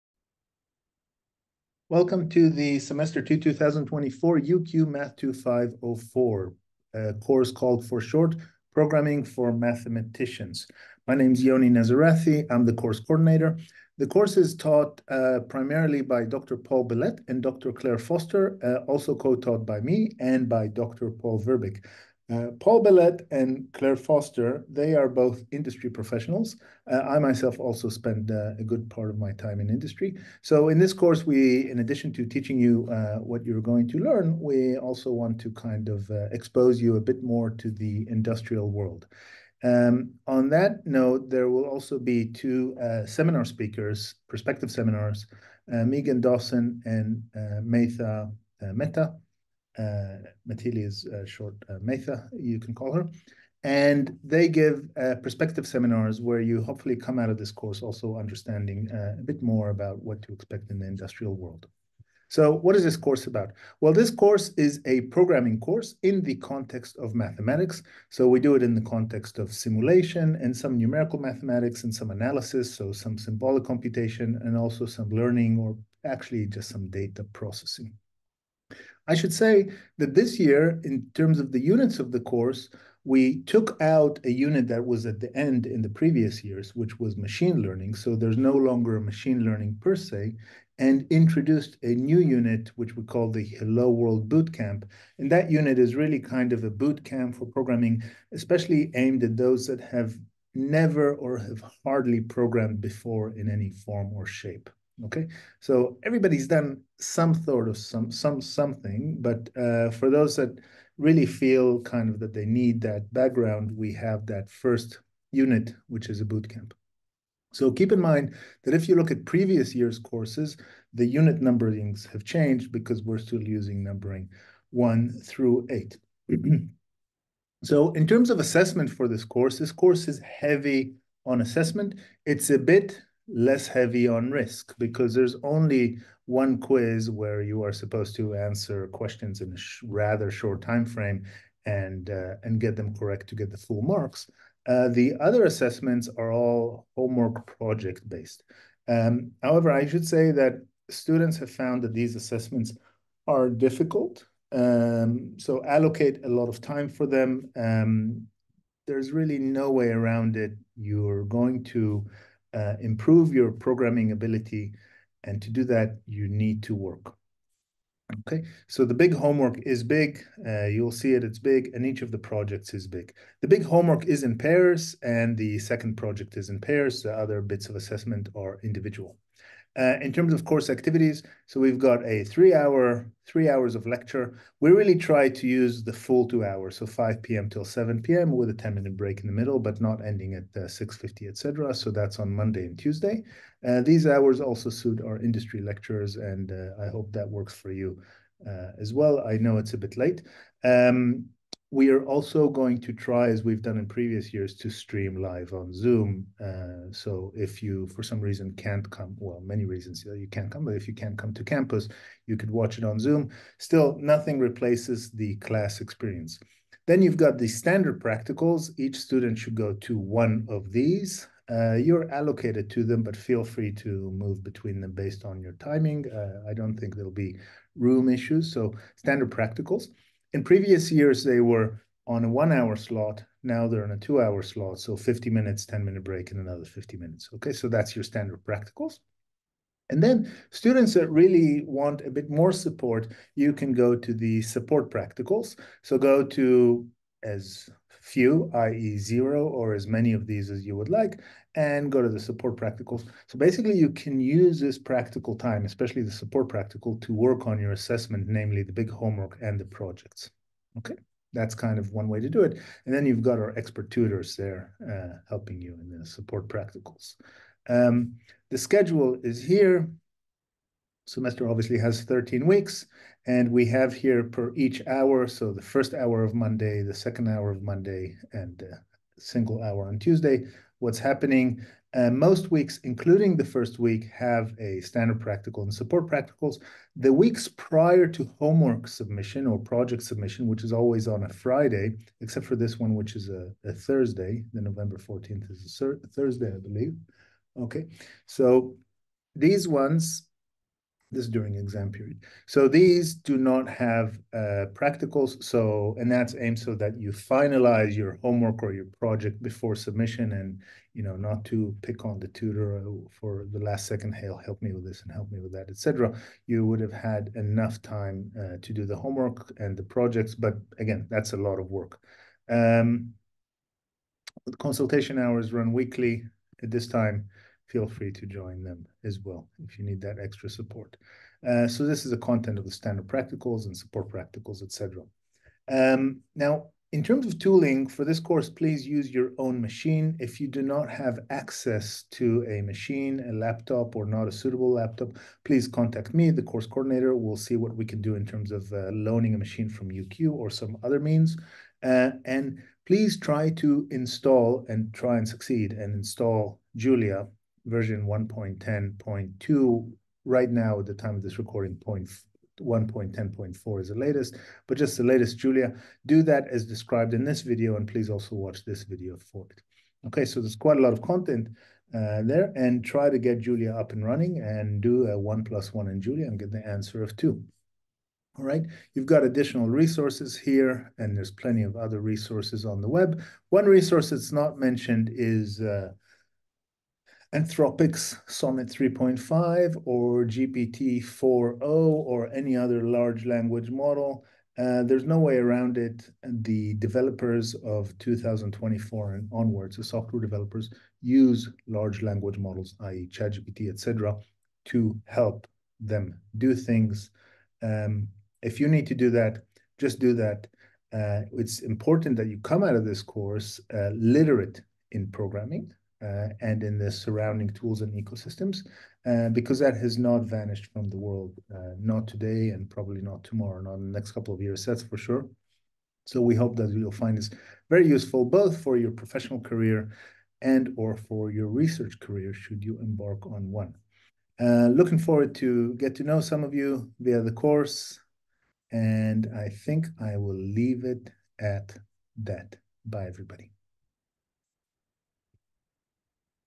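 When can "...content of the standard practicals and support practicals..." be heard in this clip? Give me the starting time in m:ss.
5:32.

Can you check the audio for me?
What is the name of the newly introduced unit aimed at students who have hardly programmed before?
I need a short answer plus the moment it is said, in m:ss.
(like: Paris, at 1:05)
Hello World Bootcamp, at 1:33.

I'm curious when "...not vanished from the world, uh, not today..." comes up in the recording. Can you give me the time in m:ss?
6:59.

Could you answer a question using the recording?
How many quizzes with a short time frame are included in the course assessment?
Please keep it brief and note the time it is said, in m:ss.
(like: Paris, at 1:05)
1, at 2:15.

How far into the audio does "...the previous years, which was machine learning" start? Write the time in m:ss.
1:25.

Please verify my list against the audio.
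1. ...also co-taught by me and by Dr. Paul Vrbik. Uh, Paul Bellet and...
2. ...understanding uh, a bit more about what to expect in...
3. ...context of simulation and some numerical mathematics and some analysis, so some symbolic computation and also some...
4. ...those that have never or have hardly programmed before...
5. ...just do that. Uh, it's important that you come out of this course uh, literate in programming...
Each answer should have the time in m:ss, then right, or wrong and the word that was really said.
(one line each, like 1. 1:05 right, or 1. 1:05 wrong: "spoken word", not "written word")
1. 0:18 right
2. 0:58 right
3. 1:08 right
4. 1:39 right
5. 6:49 right.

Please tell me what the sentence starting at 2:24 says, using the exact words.
Uh, the other assessments are all homework project based.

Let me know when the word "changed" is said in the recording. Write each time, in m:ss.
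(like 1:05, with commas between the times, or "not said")
2:02.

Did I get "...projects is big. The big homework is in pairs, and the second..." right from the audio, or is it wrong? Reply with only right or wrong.
right.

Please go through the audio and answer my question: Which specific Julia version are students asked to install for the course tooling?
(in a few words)
1.10.2.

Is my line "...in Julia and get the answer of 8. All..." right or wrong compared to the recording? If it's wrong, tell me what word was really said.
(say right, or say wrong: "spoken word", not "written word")
wrong: "2", not "8".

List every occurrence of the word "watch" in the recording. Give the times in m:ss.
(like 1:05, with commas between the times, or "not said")
3:32, 6:08.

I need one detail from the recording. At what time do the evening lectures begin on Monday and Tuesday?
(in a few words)
5 p.m.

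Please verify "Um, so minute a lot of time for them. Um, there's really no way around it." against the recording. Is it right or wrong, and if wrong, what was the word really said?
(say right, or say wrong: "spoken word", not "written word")
wrong: "allocate", not "minute".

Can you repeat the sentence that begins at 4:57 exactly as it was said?
Okay, so these ones this is during exam period.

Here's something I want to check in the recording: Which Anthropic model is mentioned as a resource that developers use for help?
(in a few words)
Sonnet 3.5.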